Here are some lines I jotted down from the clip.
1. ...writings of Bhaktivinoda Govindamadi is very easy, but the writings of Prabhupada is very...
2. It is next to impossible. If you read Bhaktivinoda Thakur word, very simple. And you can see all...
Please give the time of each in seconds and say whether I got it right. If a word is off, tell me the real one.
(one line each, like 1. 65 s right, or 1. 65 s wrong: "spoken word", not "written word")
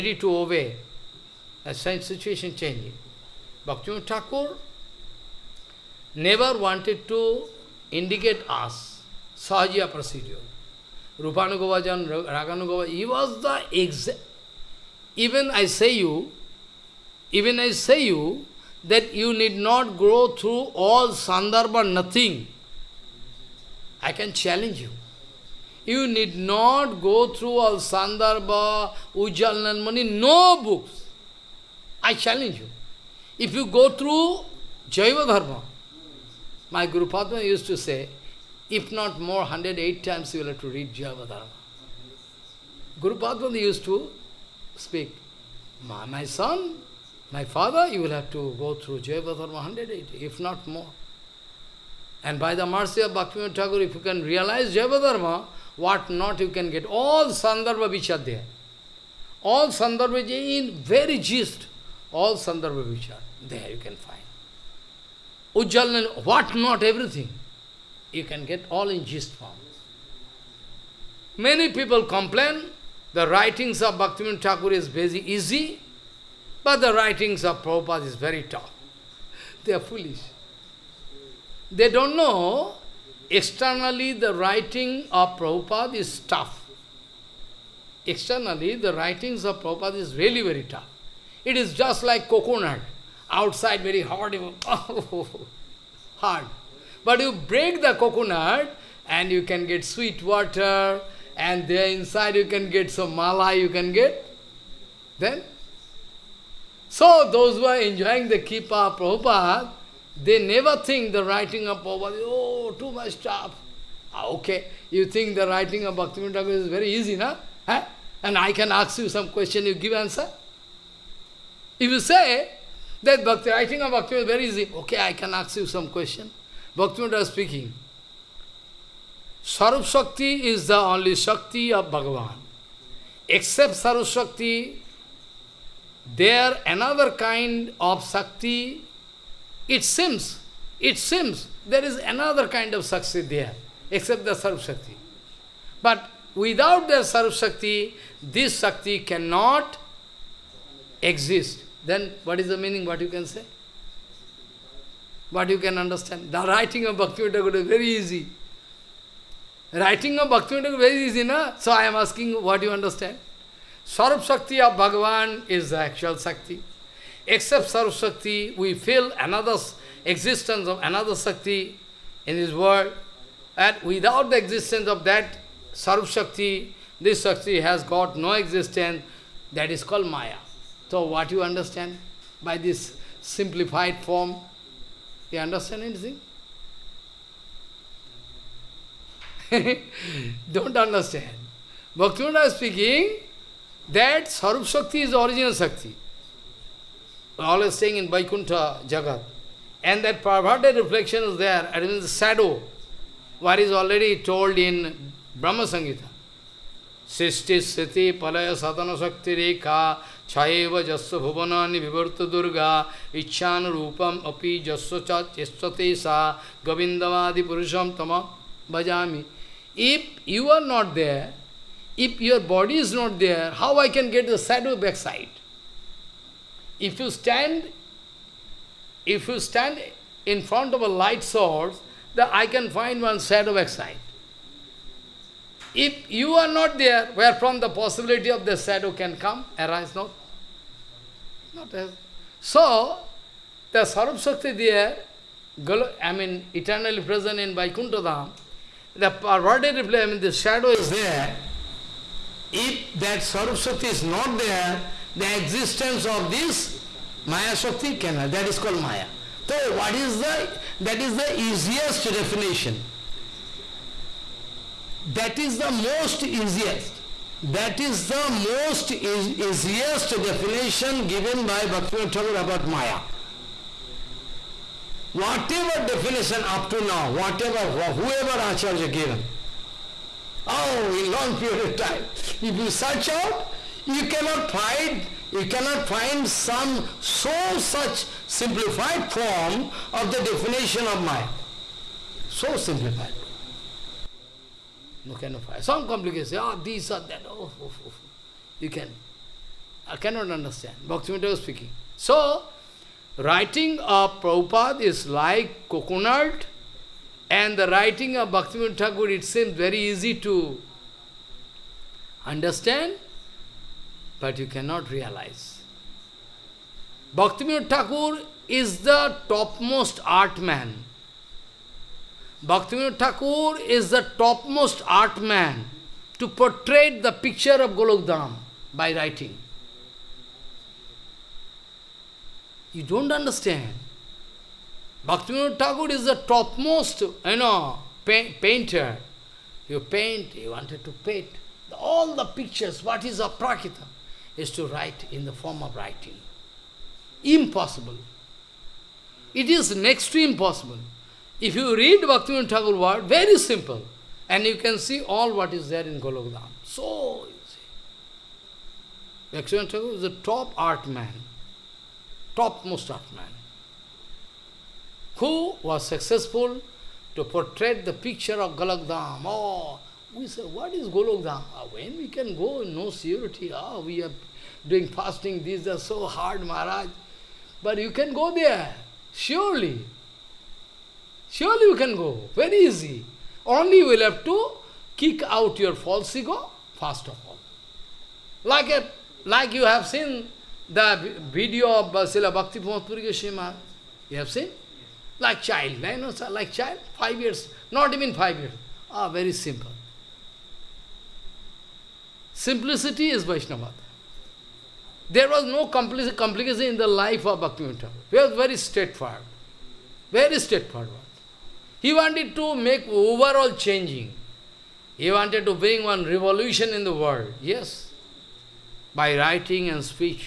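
1. 73 s wrong: "Thakur", not "Govindamadi"
2. 349 s right.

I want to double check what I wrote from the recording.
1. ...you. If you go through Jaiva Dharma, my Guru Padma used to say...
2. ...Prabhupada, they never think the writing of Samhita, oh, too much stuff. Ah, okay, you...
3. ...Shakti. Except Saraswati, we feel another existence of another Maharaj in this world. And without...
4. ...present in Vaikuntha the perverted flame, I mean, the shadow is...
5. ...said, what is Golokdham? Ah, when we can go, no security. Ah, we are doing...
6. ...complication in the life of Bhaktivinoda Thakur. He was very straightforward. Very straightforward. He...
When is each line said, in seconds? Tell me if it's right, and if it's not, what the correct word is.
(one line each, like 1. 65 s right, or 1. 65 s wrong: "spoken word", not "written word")
1. 32 s right
2. 108 s wrong: "Prabhupada", not "Samhita"
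3. 166 s wrong: "Shakti", not "Maharaj"
4. 247 s right
5. 370 s right
6. 405 s right.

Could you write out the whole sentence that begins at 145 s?
But without the Sarup Shakti, this Shakti cannot exist.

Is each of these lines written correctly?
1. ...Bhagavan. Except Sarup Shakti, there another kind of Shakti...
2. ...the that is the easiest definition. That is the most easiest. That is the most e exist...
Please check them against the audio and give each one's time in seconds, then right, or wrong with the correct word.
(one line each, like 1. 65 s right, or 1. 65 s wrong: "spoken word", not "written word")
1. 131 s right
2. 260 s wrong: "easiest", not "exist".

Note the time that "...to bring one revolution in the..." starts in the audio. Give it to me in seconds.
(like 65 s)
415 s.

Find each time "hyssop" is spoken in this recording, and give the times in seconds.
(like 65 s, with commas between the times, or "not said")
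not said.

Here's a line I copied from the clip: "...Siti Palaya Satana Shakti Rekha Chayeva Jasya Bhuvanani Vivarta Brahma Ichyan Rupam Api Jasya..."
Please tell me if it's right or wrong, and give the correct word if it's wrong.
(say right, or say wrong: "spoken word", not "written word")
wrong: "Durga", not "Brahma".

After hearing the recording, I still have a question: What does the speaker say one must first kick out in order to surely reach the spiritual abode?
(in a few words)
False ego.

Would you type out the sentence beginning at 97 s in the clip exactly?
But you break the coconut and you can get sweet water and there inside you can get some mala, you can get.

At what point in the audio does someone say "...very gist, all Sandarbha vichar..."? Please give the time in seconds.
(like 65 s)
60 s.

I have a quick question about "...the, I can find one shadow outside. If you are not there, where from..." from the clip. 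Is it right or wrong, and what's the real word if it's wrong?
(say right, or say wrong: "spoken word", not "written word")
right.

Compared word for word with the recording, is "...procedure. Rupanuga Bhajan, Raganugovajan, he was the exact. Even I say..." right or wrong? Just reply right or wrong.
right.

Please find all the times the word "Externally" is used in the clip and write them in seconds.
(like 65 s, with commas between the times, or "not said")
83 s, 88 s.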